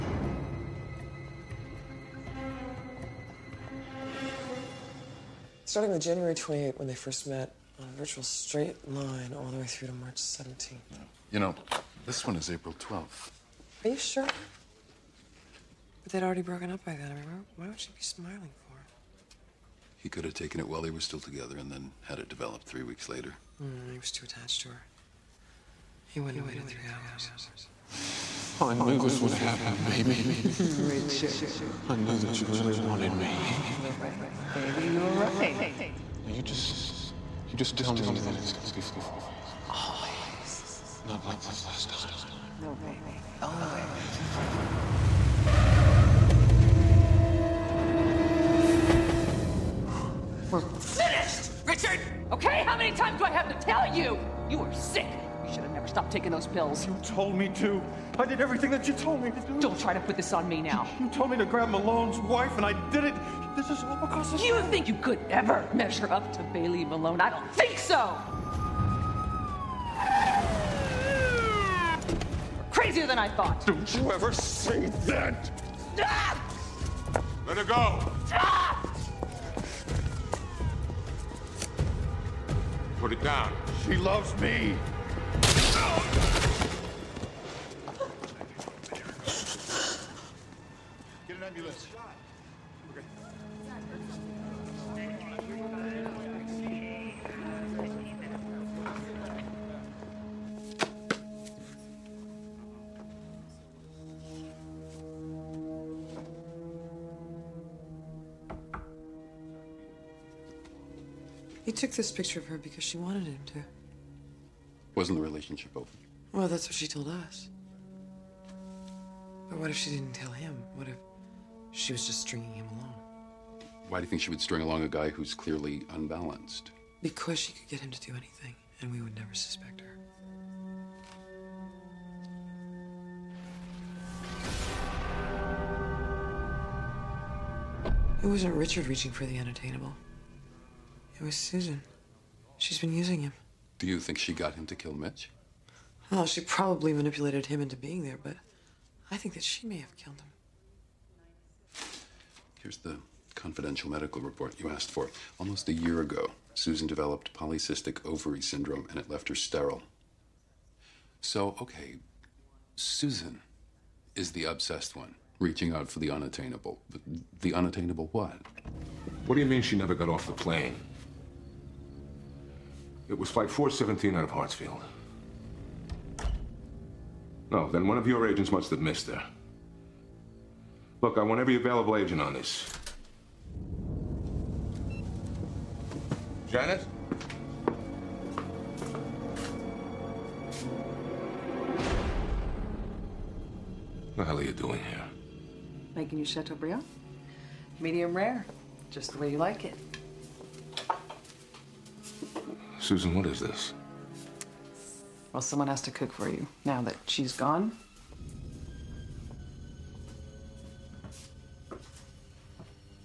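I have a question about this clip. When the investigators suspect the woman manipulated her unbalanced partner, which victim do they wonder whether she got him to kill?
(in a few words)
Mitch.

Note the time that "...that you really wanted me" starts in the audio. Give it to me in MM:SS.
00:32.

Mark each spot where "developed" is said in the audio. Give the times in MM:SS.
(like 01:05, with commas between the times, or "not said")
00:22, 02:36.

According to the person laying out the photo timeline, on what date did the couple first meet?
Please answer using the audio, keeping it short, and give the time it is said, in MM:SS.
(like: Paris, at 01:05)
January 28th, at 00:06.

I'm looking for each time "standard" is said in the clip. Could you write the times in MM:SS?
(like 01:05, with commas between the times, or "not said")
not said.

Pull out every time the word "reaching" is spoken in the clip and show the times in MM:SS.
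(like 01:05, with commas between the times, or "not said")
02:18, 02:45.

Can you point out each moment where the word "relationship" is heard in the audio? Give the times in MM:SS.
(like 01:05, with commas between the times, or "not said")
01:55.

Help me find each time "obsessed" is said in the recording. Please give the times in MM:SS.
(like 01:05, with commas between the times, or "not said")
02:44.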